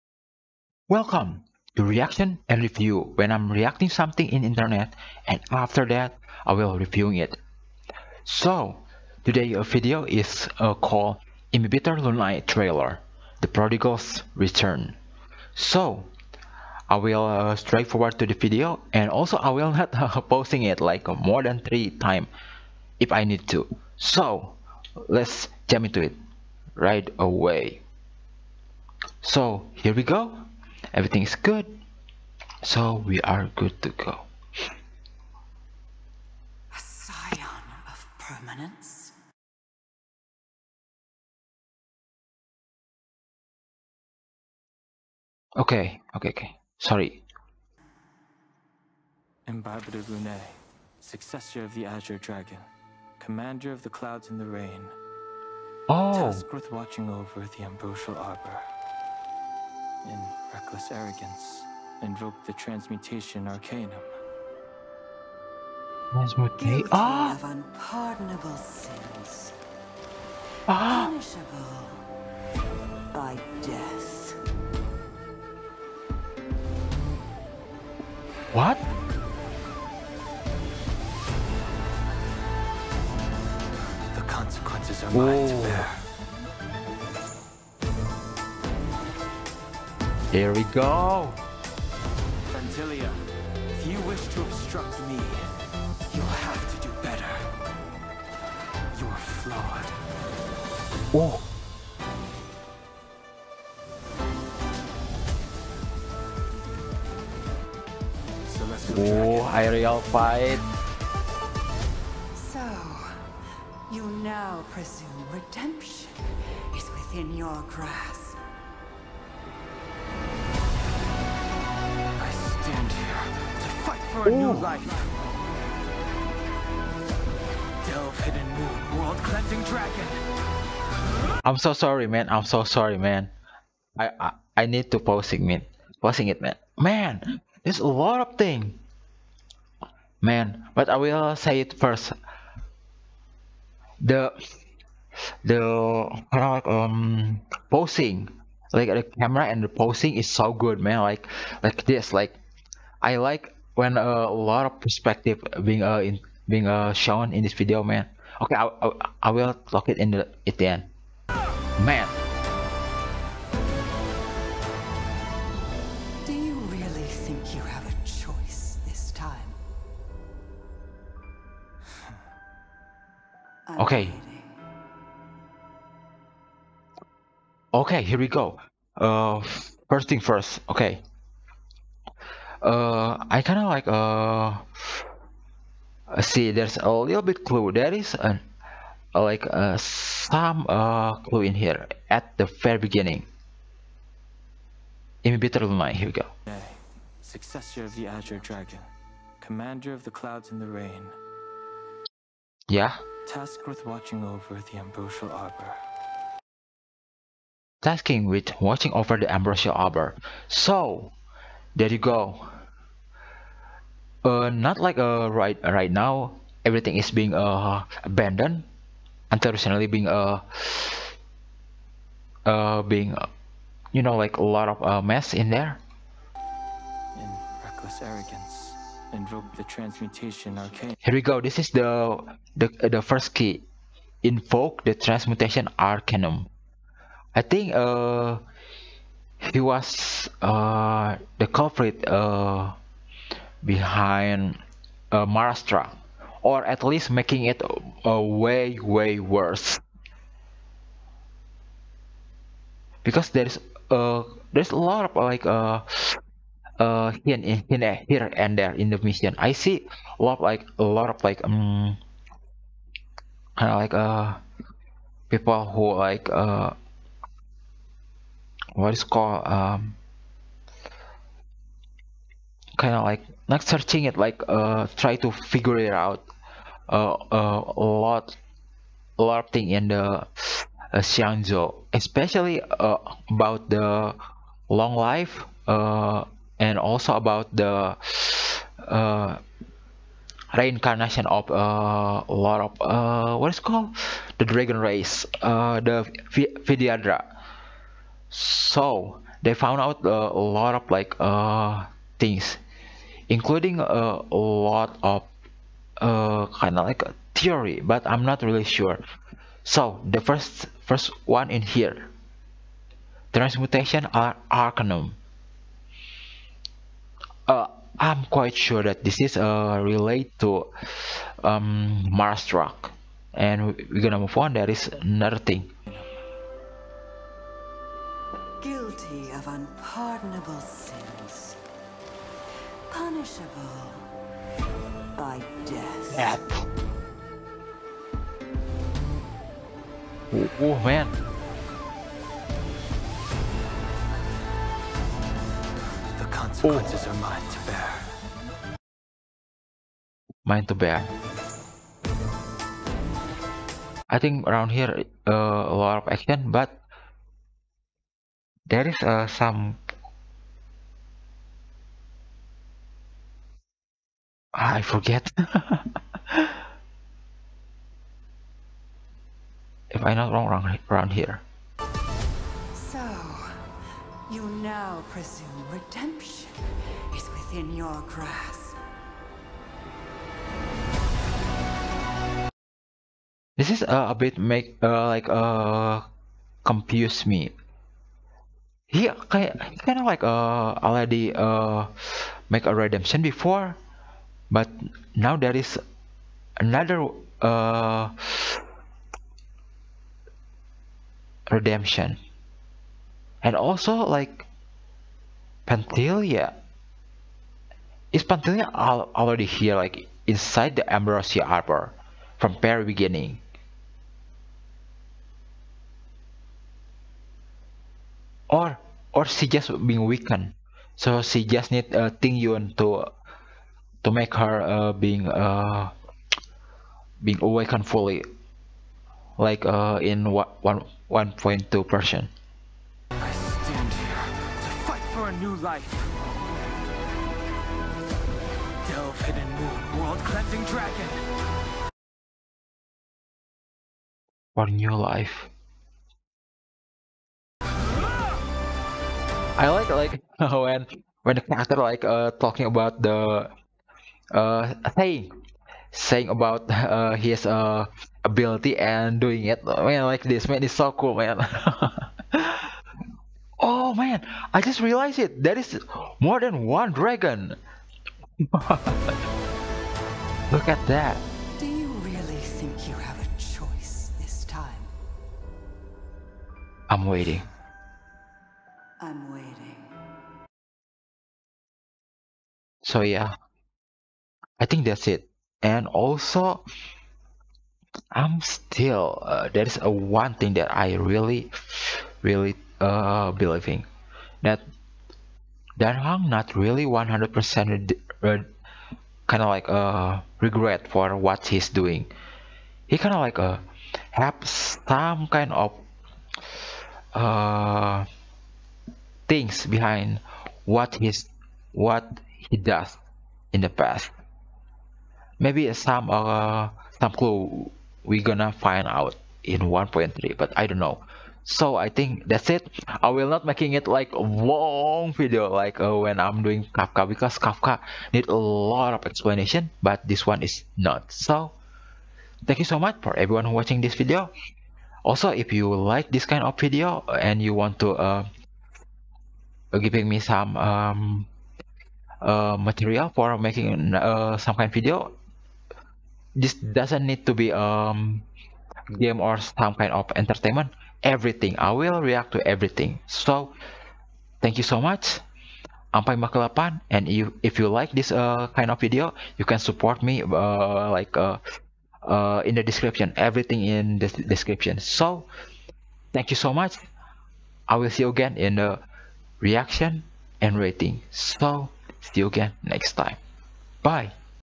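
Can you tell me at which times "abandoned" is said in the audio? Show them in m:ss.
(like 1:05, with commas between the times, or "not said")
3:38.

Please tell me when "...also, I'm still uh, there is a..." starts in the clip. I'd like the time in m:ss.
8:05.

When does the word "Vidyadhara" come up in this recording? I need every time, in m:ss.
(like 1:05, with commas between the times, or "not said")
4:56.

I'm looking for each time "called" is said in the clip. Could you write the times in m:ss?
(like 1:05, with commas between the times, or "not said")
0:10, 4:29, 4:53.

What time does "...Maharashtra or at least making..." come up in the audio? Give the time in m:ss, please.
4:05.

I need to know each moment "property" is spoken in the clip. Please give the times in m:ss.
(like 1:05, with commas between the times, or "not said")
not said.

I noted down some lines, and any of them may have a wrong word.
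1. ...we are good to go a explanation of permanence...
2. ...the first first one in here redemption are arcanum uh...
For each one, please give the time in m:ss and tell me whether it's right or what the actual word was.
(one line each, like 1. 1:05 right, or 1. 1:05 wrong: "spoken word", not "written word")
1. 0:33 wrong: "scion", not "explanation"
2. 5:10 wrong: "transmutation", not "redemption".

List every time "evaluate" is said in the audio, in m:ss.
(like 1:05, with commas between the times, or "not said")
not said.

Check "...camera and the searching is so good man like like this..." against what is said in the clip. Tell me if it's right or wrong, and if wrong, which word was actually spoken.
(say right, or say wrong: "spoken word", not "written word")
wrong: "posing", not "searching".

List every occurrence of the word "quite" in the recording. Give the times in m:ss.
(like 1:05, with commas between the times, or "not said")
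5:18.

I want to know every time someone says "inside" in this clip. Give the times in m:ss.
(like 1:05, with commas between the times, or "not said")
6:50.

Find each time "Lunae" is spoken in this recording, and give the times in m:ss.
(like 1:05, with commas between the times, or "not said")
0:11, 0:50, 3:15.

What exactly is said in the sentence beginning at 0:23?
So let's jump into it right away.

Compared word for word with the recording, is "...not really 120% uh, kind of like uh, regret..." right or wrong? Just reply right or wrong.
wrong.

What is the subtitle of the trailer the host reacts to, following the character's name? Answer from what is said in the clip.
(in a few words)
The Prodigal's Return.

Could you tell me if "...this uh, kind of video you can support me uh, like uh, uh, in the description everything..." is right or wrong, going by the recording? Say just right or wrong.
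right.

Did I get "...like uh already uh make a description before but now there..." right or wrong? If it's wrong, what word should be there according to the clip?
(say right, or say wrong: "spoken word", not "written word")
wrong: "redemption", not "description".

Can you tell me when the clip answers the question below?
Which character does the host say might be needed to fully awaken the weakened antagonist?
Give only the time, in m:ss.
7:02.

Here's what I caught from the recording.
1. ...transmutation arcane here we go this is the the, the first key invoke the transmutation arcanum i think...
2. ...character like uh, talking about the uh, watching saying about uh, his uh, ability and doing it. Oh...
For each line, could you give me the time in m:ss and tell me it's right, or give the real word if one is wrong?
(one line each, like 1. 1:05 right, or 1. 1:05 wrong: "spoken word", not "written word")
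1. 3:49 right
2. 7:31 wrong: "saying", not "watching".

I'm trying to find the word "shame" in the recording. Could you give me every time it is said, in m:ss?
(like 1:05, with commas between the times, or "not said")
not said.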